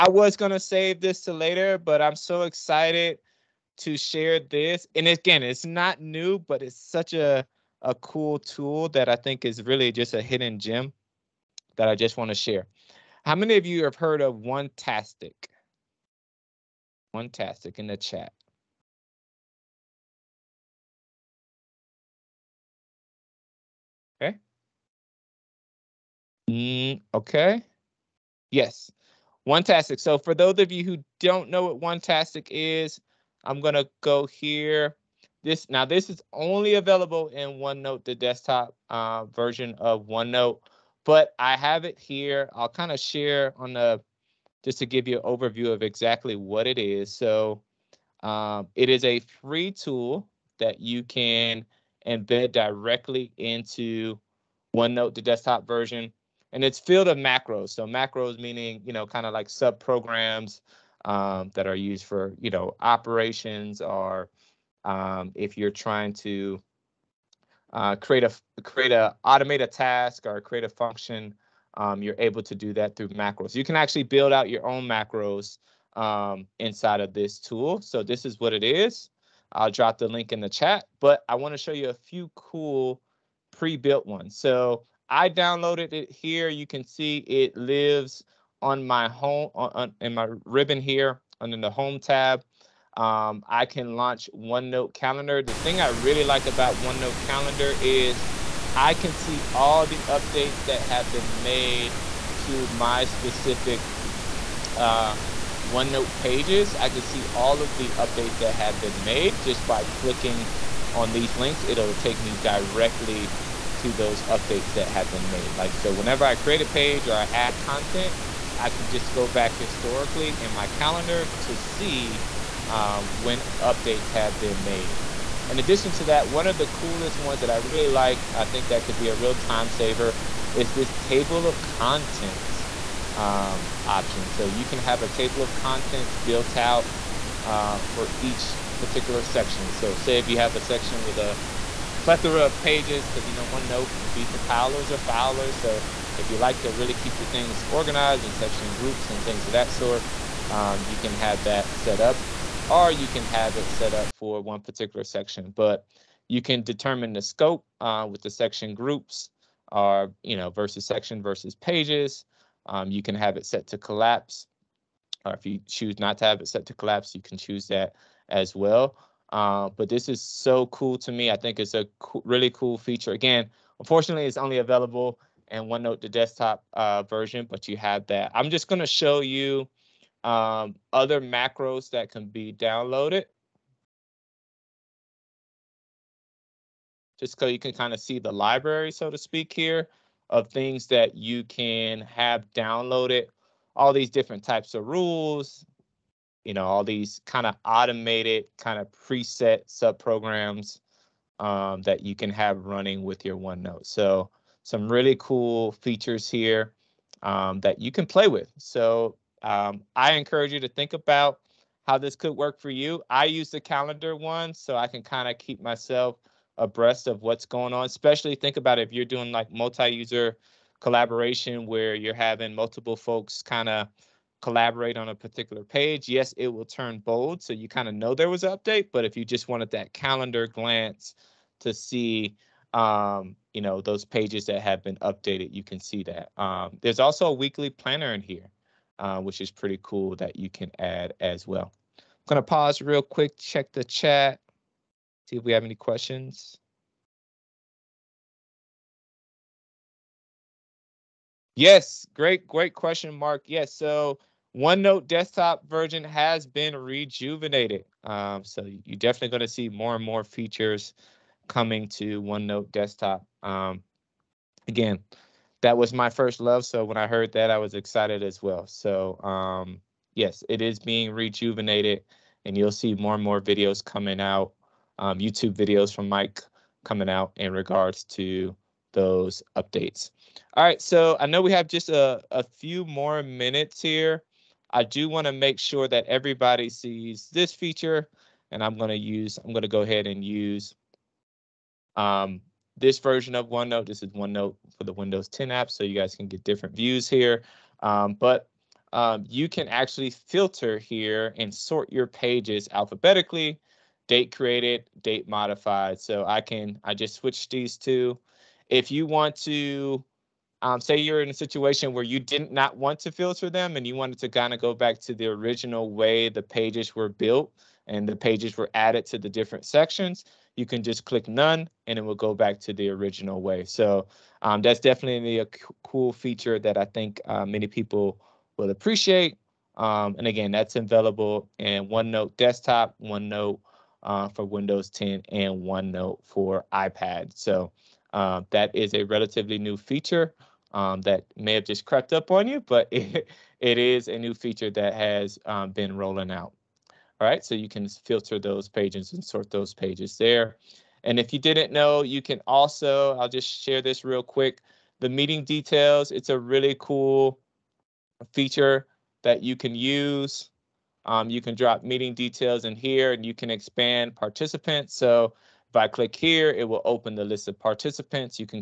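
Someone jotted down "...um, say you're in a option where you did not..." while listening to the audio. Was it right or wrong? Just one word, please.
wrong.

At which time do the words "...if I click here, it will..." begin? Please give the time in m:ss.
6:05.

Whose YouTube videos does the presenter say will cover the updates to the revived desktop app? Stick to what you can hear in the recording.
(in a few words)
Mike.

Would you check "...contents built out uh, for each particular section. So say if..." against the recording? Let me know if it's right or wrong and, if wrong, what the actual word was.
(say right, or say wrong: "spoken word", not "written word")
right.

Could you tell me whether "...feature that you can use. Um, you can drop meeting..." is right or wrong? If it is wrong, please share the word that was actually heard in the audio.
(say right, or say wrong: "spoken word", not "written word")
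right.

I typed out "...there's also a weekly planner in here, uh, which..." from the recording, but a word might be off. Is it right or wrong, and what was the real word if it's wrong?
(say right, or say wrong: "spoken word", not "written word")
right.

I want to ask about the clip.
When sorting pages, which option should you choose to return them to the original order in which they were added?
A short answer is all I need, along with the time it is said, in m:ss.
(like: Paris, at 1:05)
None, at 5:21.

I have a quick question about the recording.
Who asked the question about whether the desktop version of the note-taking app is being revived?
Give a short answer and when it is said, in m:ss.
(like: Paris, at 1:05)
Mark, at 4:13.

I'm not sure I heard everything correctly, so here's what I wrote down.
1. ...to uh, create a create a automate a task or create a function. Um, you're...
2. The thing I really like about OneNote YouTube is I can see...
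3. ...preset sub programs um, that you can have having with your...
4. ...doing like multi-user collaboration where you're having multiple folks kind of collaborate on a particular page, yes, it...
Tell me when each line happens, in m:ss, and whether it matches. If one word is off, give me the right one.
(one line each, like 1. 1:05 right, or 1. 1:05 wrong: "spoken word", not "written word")
1. 1:06 right
2. 1:35 wrong: "Calendar", not "YouTube"
3. 3:18 wrong: "running", not "having"
4. 3:39 right.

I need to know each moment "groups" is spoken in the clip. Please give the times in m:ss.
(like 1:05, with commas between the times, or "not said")
2:28, 2:38.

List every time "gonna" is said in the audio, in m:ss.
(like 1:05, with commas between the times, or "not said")
0:00, 0:33.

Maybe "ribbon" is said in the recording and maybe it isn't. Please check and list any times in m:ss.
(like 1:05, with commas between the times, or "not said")
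1:30.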